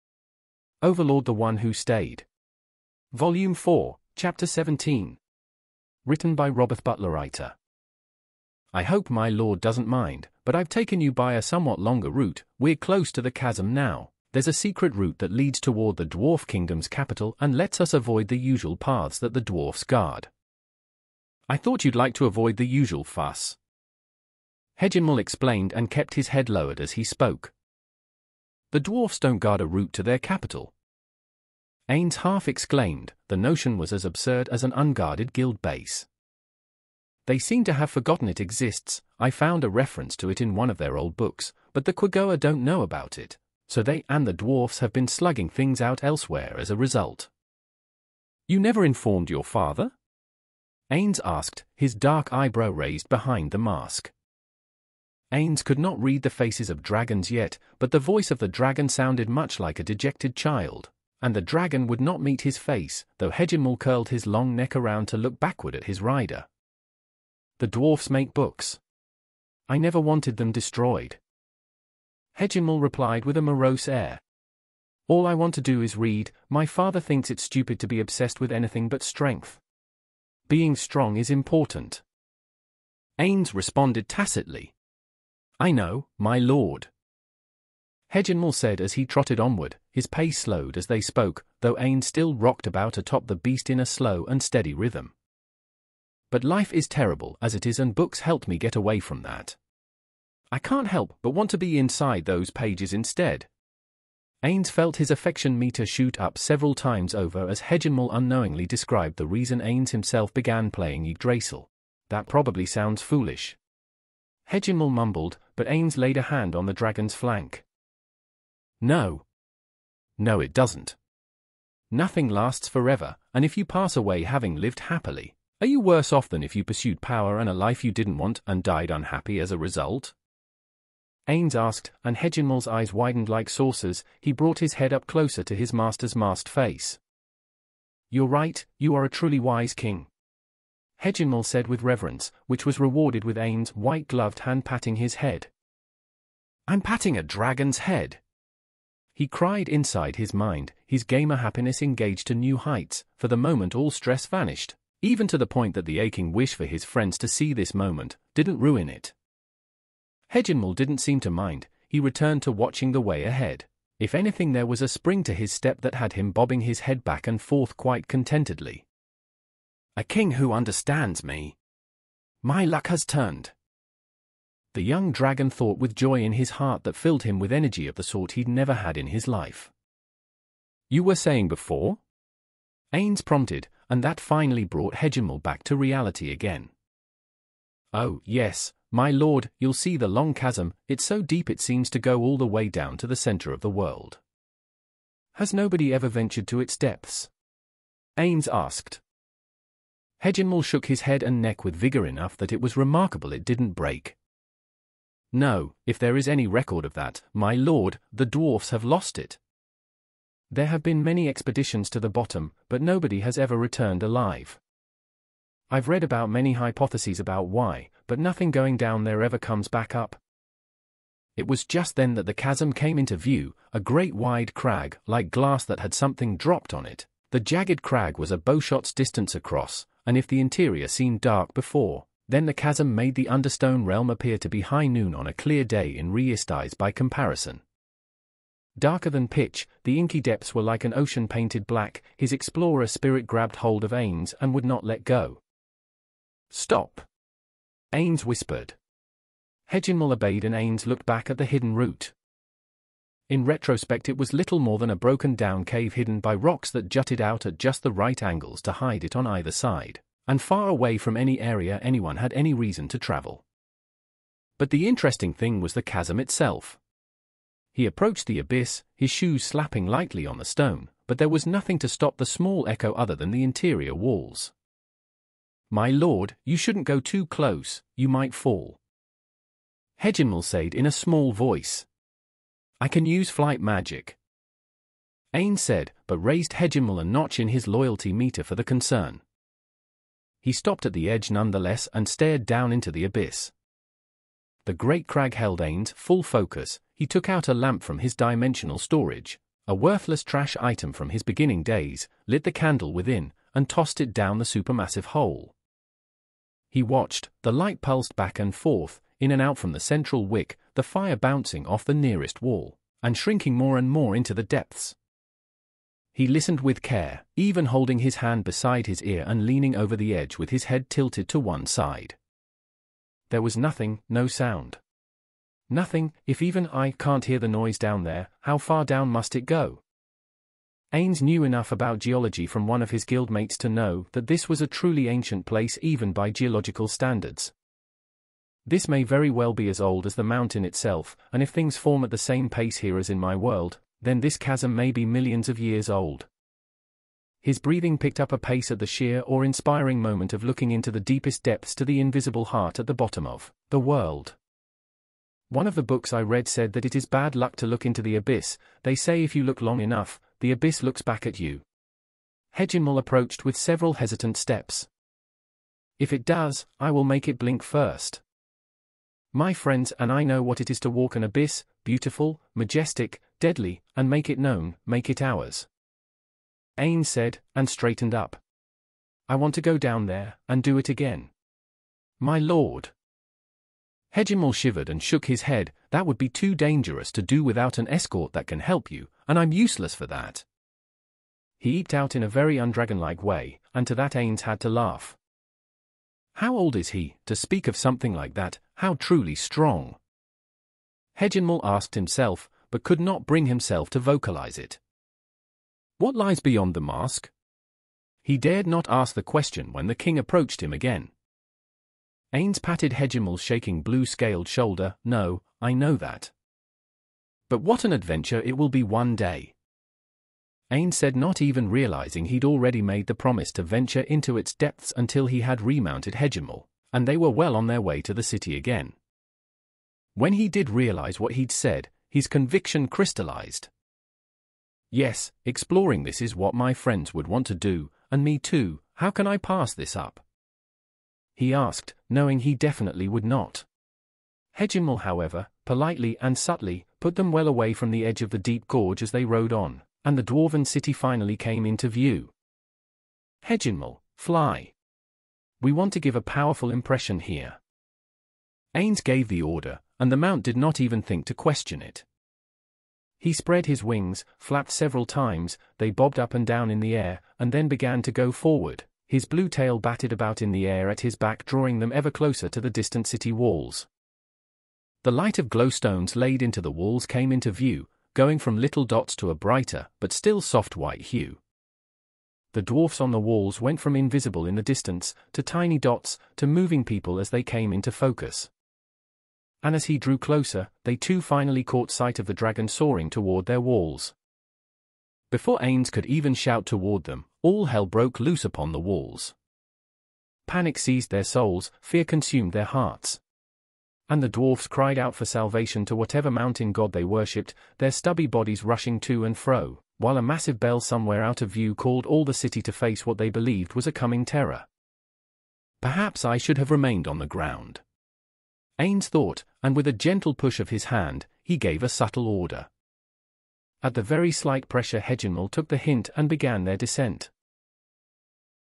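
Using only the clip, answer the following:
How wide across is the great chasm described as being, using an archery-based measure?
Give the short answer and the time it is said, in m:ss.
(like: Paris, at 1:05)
a bowshot's distance, at 3:48.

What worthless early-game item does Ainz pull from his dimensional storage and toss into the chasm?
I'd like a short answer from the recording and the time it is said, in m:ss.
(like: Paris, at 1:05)
a lamp, at 4:57.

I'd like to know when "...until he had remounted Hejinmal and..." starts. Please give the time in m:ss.
7:04.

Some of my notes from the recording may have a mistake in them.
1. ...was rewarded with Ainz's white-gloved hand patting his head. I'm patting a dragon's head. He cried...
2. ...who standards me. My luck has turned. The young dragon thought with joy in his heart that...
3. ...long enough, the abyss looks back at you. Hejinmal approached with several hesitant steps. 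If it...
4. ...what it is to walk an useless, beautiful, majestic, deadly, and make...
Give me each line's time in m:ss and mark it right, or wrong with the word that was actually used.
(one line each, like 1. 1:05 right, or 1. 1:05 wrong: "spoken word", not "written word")
1. 2:22 right
2. 2:50 wrong: "understands", not "standards"
3. 5:59 right
4. 6:10 wrong: "abyss", not "useless".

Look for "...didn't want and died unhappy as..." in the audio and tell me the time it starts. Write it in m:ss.
2:07.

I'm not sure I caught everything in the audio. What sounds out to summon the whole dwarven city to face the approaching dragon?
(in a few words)
a massive bell.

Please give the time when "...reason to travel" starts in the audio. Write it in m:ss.
4:22.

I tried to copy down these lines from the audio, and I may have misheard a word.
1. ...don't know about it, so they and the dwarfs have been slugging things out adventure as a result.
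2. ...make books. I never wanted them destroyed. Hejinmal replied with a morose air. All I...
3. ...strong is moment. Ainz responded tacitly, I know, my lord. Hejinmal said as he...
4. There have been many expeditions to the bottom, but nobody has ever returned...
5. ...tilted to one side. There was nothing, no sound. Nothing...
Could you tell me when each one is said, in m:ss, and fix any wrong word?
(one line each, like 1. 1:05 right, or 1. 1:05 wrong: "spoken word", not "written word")
1. 0:42 wrong: "elsewhere", not "adventure"
2. 1:08 right
3. 1:20 wrong: "important", not "moment"
4. 3:30 right
5. 5:20 right.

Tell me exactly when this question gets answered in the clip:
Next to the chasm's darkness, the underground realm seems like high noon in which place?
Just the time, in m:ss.
3:56.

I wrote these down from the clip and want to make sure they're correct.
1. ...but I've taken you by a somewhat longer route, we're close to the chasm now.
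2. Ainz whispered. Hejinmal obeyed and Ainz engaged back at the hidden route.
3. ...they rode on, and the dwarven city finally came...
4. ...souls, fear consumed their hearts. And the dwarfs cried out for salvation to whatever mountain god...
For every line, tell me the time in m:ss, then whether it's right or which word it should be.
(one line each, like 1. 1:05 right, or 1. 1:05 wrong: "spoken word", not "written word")
1. 0:10 right
2. 4:07 wrong: "looked", not "engaged"
3. 7:29 right
4. 8:21 right.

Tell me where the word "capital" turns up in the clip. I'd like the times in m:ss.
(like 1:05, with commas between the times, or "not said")
0:16, 0:30.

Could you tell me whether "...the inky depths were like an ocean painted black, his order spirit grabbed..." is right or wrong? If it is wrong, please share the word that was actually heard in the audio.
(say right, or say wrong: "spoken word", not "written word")
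wrong: "explorer", not "order".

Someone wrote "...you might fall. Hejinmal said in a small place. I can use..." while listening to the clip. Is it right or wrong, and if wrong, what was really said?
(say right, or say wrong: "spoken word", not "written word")
wrong: "voice", not "place".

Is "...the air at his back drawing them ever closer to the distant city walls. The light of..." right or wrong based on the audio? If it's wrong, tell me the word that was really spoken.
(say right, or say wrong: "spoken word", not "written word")
right.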